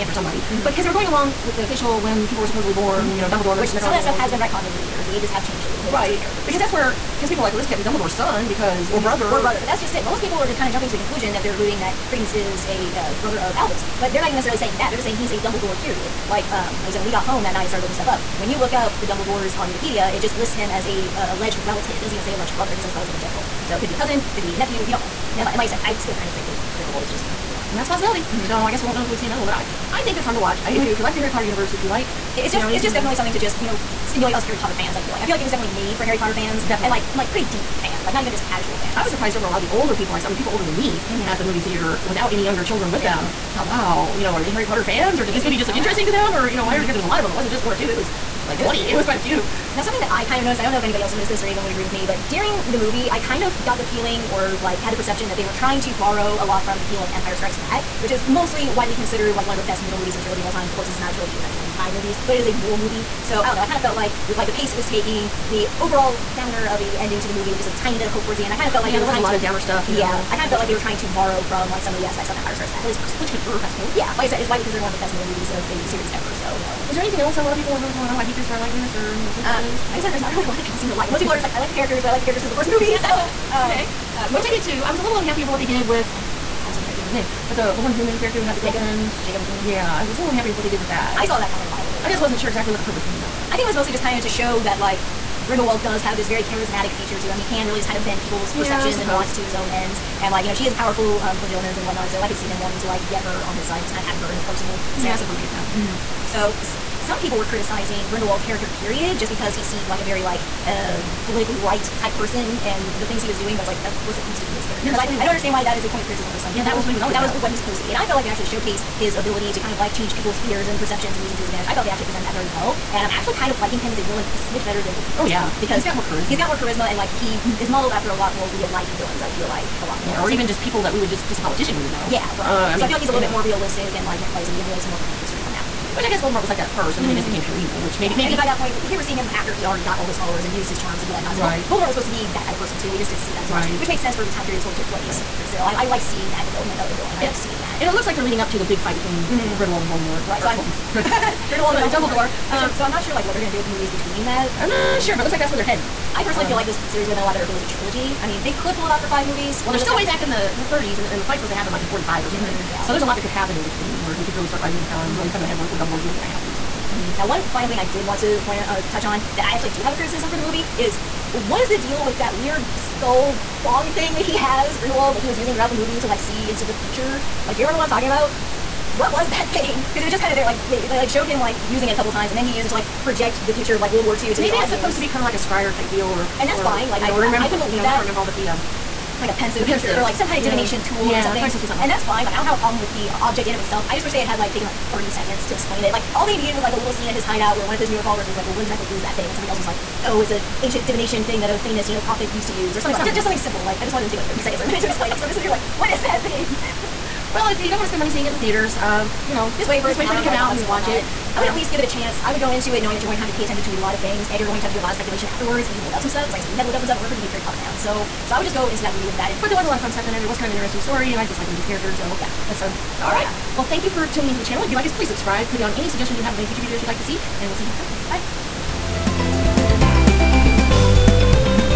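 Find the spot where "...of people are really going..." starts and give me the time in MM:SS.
01:17.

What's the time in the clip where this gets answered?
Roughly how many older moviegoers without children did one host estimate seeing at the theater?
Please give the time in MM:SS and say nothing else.
00:48.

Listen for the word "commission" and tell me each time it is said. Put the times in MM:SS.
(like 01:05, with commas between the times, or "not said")
not said.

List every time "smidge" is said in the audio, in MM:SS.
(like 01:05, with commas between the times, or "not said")
02:04.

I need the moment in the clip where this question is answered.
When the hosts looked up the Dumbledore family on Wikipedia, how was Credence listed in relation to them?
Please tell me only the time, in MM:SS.
00:21.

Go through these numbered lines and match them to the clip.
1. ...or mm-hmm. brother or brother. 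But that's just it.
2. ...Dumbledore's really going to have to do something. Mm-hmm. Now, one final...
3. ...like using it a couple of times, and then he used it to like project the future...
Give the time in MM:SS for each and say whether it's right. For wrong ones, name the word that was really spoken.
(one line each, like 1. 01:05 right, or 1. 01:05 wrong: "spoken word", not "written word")
1. 00:08 right
2. 02:45 right
3. 03:01 right.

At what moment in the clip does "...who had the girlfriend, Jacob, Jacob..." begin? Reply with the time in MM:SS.
01:28.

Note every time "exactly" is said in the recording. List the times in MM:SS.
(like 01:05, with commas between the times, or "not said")
01:32, 03:18.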